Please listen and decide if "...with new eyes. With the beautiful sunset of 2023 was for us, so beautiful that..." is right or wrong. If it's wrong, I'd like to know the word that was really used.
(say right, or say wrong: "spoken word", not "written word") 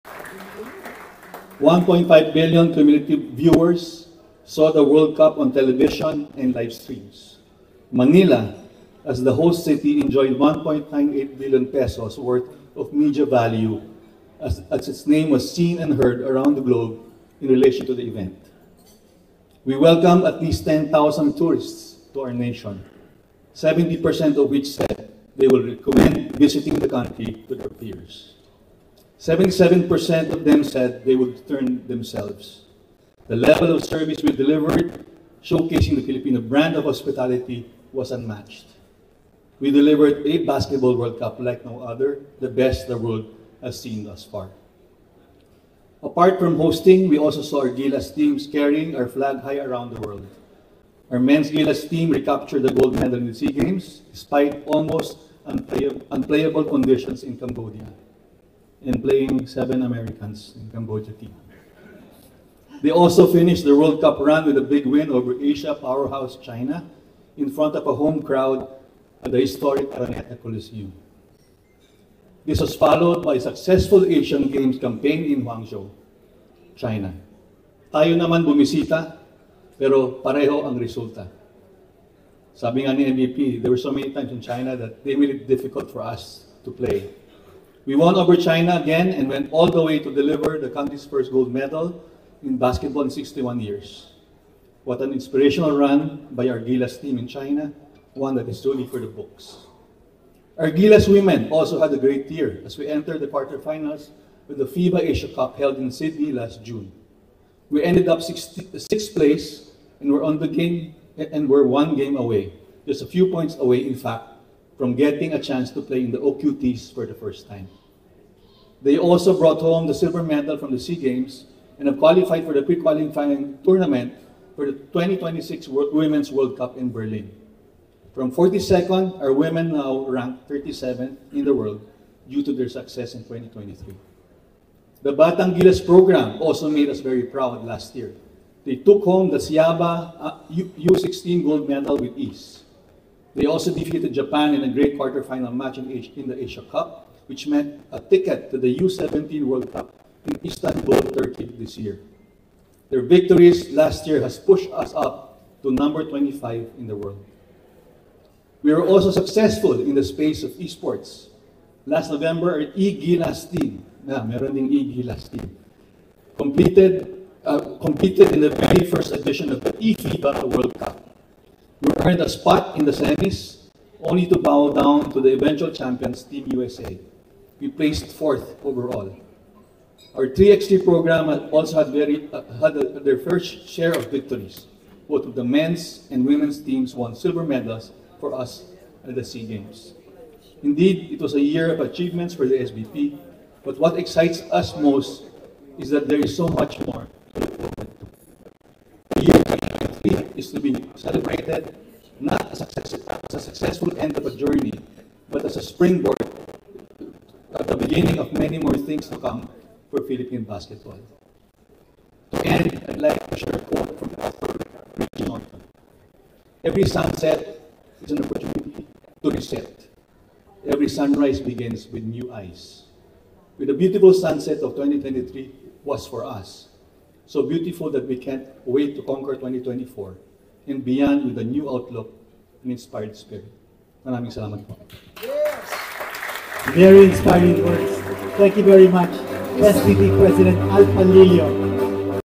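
right.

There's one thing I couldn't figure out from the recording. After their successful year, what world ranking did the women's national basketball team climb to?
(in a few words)
37th.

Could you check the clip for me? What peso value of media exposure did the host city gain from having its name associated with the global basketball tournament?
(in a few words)
1.98 billion pesos.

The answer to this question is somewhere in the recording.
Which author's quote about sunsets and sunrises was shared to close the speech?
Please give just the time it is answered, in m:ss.
3:34.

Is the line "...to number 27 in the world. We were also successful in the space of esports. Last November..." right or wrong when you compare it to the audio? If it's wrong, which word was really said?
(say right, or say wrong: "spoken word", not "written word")
wrong: "25", not "27".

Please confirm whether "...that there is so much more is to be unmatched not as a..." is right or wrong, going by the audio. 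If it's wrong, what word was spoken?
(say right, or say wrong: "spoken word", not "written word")
wrong: "celebrated", not "unmatched".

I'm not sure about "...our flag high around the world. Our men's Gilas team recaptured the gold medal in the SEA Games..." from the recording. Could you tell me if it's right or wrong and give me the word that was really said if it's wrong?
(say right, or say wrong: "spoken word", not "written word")
right.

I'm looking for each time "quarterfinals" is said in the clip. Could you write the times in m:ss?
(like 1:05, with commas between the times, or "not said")
1:43, 2:24.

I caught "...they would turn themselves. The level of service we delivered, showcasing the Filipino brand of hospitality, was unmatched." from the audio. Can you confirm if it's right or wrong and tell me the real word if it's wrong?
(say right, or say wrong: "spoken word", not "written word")
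right.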